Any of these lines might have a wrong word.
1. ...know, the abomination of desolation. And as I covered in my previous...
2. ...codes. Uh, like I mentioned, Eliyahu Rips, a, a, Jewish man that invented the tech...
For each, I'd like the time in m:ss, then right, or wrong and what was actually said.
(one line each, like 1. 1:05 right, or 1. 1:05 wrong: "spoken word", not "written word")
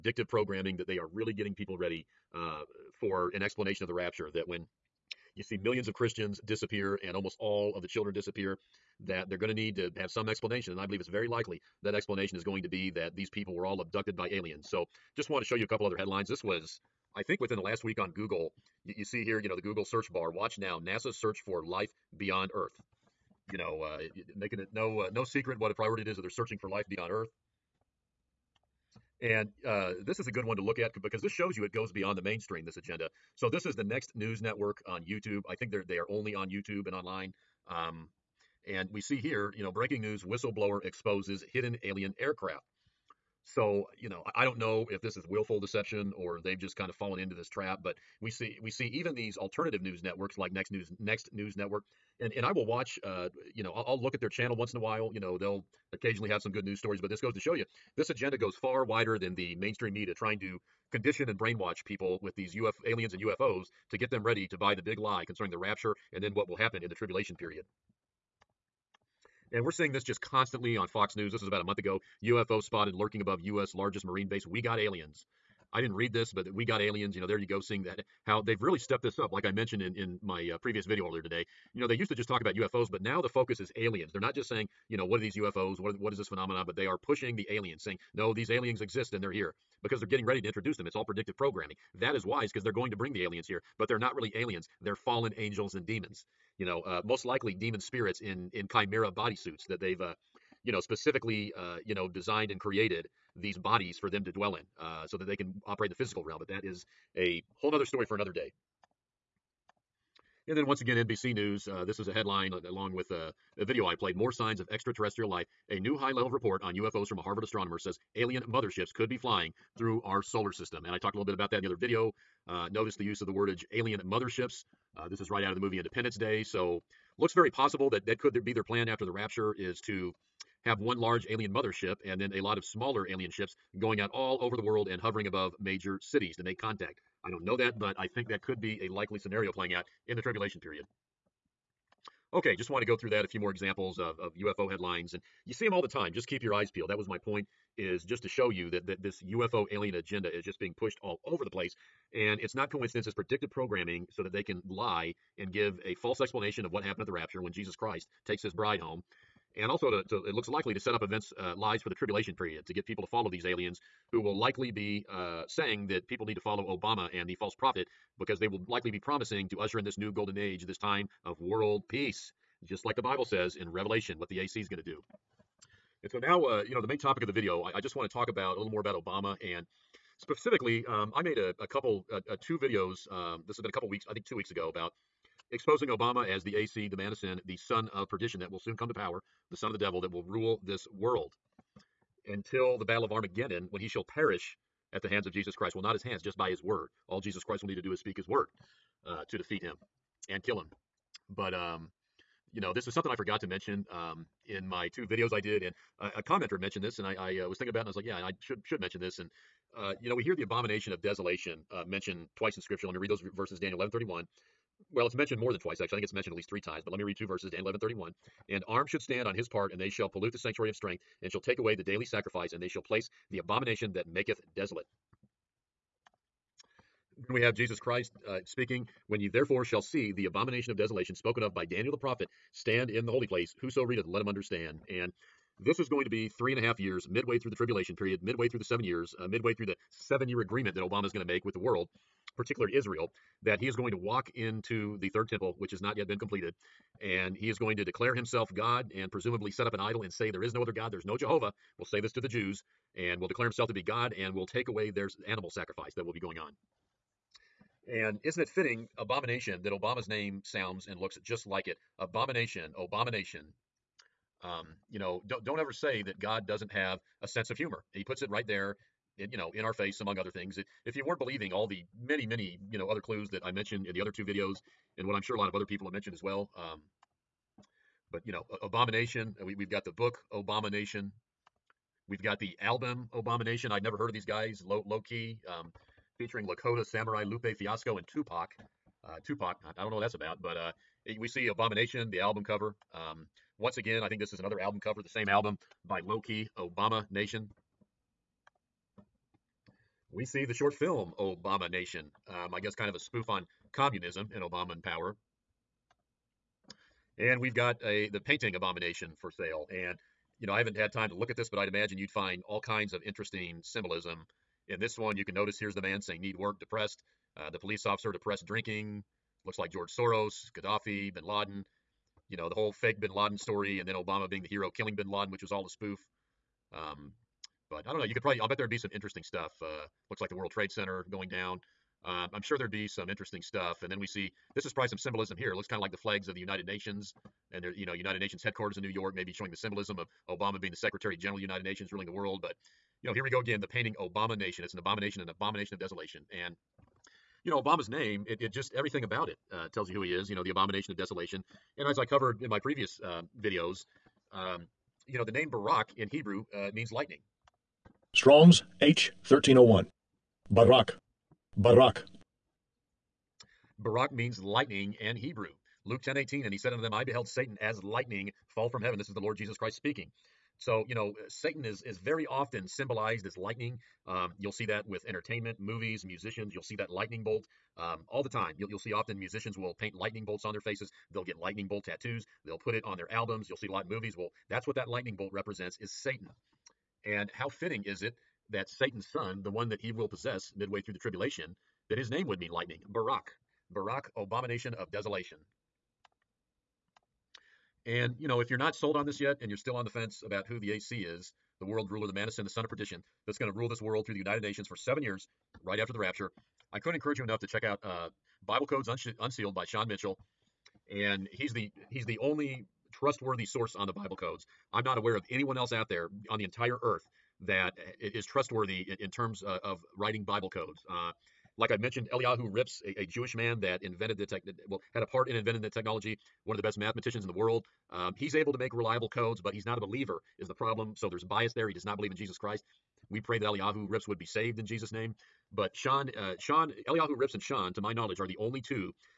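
1. 5:50 right
2. 7:00 right.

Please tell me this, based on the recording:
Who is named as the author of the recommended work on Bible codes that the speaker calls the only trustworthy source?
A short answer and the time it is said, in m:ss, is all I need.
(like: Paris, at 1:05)
Sean Mitchell, at 6:49.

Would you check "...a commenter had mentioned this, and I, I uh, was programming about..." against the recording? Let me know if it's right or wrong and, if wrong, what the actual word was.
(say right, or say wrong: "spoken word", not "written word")
wrong: "thinking", not "programming".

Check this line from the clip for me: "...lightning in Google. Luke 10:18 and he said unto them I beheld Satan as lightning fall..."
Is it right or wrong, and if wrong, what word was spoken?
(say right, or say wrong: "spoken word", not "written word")
wrong: "Hebrew", not "Google".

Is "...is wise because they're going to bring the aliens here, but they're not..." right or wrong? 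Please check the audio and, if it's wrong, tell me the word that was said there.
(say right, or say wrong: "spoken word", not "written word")
right.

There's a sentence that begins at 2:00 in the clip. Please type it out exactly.
And I talked a little bit about that in the other video.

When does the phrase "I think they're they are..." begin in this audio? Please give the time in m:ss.
0:35.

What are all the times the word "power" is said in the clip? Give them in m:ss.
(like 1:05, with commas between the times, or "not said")
3:08, 5:04.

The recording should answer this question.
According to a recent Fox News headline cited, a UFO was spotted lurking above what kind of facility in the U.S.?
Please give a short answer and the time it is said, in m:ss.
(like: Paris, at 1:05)
Largest marine base, at 1:13.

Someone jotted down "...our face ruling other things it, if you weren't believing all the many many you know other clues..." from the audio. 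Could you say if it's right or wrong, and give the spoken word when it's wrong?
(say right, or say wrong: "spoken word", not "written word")
wrong: "among", not "ruling".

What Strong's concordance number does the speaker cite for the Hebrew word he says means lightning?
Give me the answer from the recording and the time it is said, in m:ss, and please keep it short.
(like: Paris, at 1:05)
H1301, at 5:58.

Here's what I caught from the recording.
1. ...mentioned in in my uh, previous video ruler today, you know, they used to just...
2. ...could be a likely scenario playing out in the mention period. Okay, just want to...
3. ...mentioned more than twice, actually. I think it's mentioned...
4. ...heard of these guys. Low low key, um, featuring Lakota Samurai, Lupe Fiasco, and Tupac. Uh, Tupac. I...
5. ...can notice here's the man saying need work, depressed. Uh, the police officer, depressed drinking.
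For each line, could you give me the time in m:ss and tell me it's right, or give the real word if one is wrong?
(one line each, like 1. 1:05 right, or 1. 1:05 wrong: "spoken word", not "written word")
1. 1:19 wrong: "earlier", not "ruler"
2. 2:18 wrong: "tribulation", not "mention"
3. 3:35 right
4. 4:43 right
5. 5:15 right.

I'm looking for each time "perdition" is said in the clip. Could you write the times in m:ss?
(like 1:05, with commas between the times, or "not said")
3:08, 6:42.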